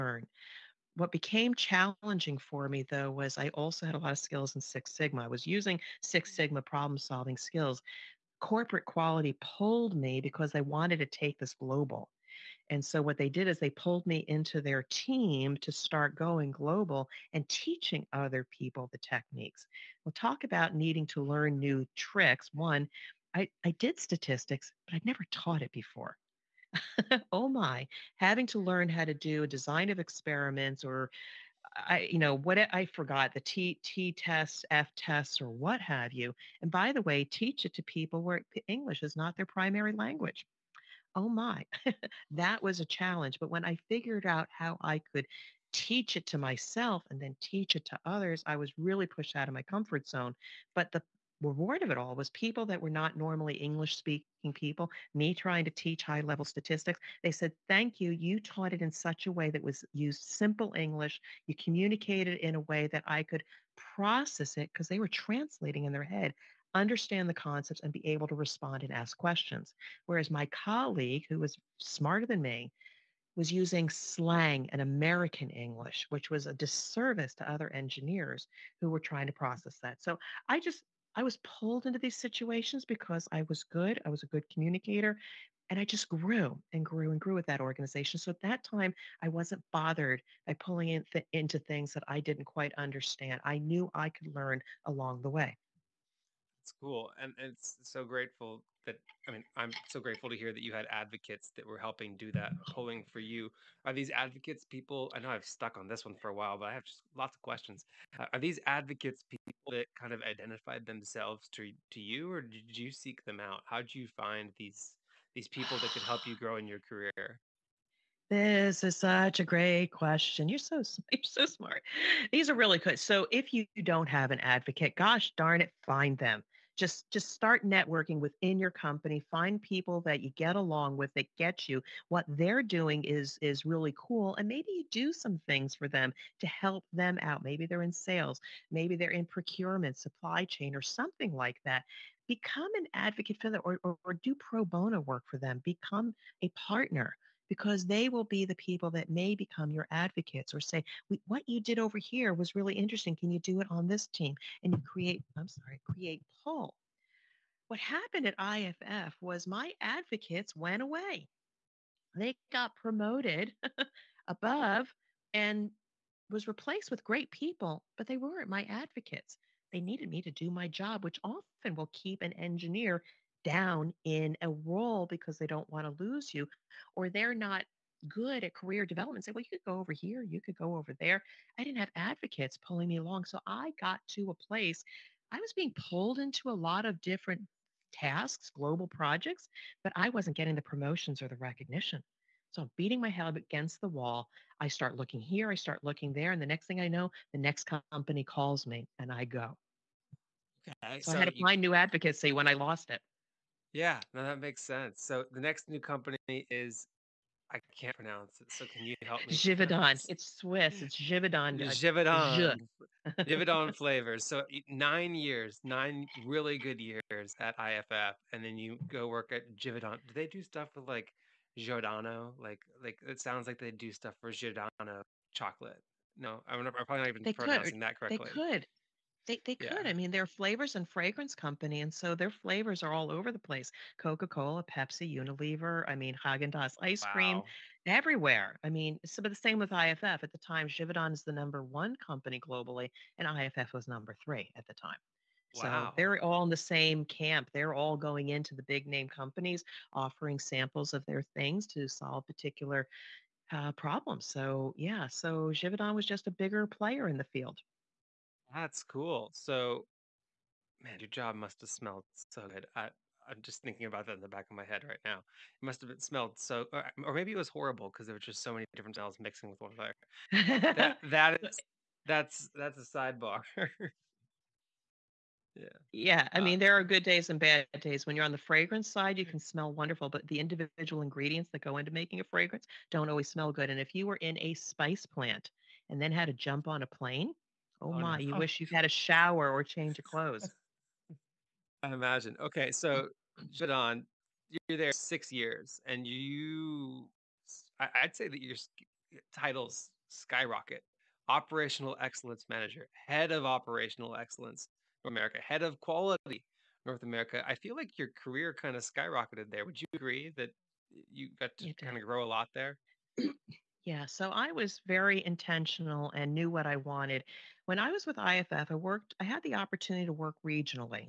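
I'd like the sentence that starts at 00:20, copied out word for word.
We'll talk about needing to learn new tricks.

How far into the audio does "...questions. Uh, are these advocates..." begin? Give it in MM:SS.
01:47.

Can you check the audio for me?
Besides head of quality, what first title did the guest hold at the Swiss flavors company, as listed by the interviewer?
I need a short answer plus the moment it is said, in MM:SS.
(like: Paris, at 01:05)
Operational Excellence Manager, at 05:01.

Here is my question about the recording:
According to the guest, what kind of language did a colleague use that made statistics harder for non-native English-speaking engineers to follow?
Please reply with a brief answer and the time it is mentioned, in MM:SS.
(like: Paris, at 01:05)
slang and American English, at 01:13.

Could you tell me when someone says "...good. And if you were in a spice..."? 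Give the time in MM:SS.
04:43.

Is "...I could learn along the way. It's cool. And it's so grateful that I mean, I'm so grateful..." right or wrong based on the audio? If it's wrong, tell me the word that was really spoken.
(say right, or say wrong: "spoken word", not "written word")
right.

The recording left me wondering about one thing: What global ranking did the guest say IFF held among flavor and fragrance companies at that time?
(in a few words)
number three.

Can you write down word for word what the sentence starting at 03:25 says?
So the next new company is I can't pronounce it.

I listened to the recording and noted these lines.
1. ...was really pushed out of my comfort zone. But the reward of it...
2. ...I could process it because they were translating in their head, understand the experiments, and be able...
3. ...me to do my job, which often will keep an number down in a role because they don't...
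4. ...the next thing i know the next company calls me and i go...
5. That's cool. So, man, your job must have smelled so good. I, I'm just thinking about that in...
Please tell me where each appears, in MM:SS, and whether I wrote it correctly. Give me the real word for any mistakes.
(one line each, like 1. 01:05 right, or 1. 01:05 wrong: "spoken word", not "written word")
1. 00:48 right
2. 01:03 wrong: "concepts", not "experiments"
3. 02:50 wrong: "engineer", not "number"
4. 03:16 right
5. 04:18 right.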